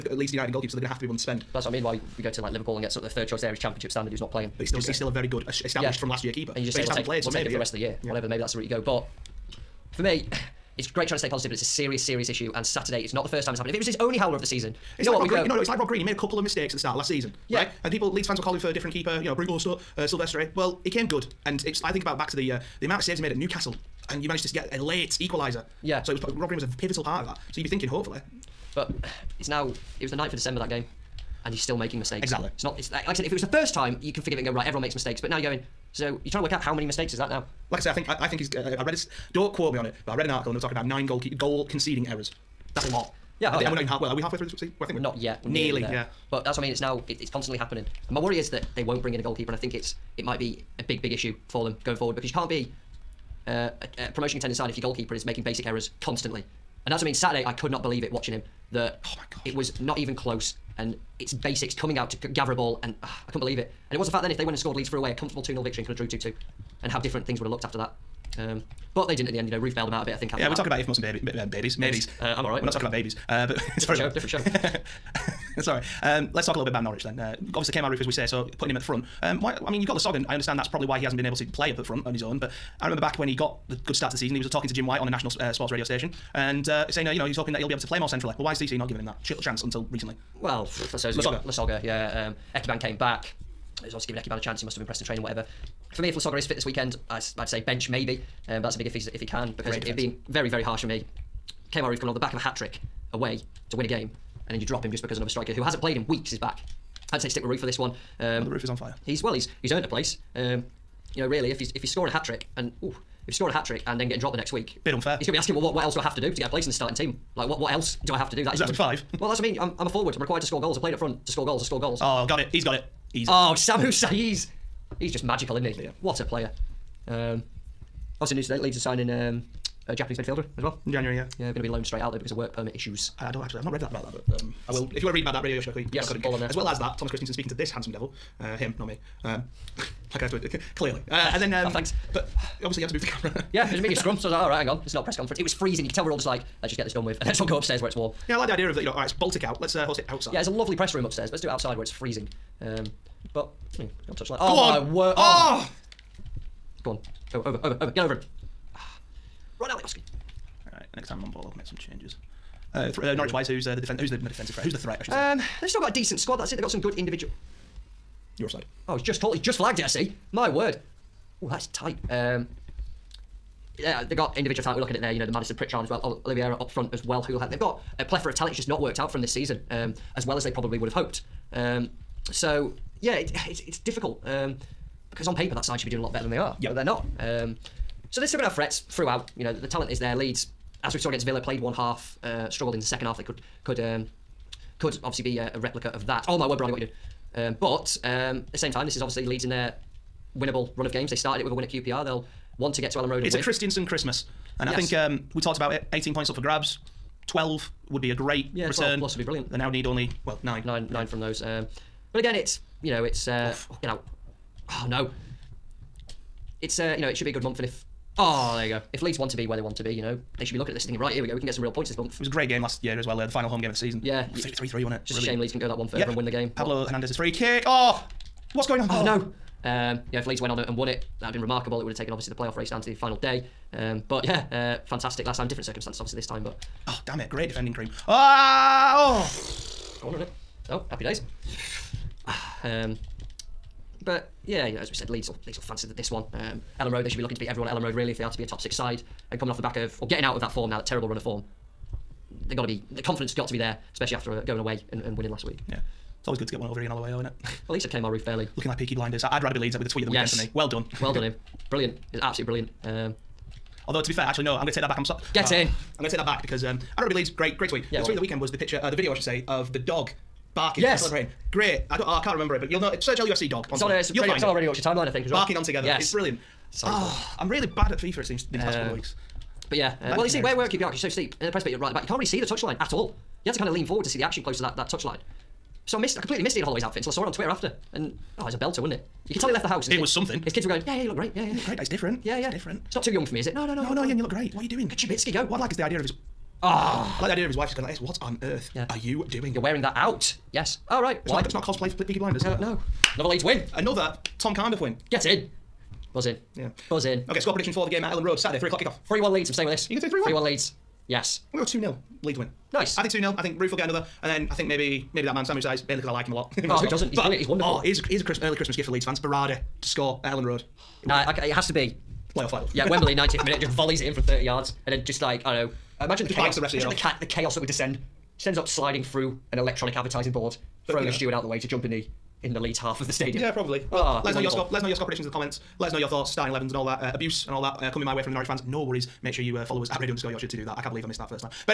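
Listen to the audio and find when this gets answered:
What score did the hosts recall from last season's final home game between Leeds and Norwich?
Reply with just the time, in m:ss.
3:44.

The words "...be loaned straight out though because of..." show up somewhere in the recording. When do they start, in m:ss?
2:11.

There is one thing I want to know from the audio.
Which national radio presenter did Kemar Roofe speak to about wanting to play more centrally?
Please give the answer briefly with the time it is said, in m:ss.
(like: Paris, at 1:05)
Jim White, at 1:24.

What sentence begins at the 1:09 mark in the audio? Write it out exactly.
You know, Roofe bailed them out a bit.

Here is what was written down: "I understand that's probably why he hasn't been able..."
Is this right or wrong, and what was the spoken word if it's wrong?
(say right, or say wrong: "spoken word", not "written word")
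right.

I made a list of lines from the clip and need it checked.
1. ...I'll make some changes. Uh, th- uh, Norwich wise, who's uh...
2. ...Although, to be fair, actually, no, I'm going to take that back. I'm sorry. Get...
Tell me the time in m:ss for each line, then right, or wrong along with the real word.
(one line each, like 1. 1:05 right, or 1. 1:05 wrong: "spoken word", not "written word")
1. 2:41 right
2. 4:23 right.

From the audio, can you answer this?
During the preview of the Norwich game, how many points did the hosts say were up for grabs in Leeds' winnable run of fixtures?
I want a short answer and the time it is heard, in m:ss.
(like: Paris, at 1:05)
18, at 3:25.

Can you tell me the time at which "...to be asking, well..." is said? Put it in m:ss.
1:55.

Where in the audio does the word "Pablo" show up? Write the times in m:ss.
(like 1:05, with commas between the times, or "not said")
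3:46.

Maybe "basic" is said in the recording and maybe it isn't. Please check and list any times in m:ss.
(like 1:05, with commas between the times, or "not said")
0:55, 1:01.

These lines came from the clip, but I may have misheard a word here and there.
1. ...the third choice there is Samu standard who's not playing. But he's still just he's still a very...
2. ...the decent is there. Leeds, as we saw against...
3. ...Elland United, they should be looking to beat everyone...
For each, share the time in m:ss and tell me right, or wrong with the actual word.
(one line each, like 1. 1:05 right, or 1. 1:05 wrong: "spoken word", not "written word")
1. 0:03 wrong: "Championship", not "Samu"
2. 3:09 wrong: "talent", not "decent"
3. 4:06 wrong: "Road", not "United".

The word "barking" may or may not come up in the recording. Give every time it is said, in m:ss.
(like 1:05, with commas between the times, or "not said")
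4:30, 4:35.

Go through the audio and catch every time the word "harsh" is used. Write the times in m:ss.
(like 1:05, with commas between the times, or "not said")
1:40.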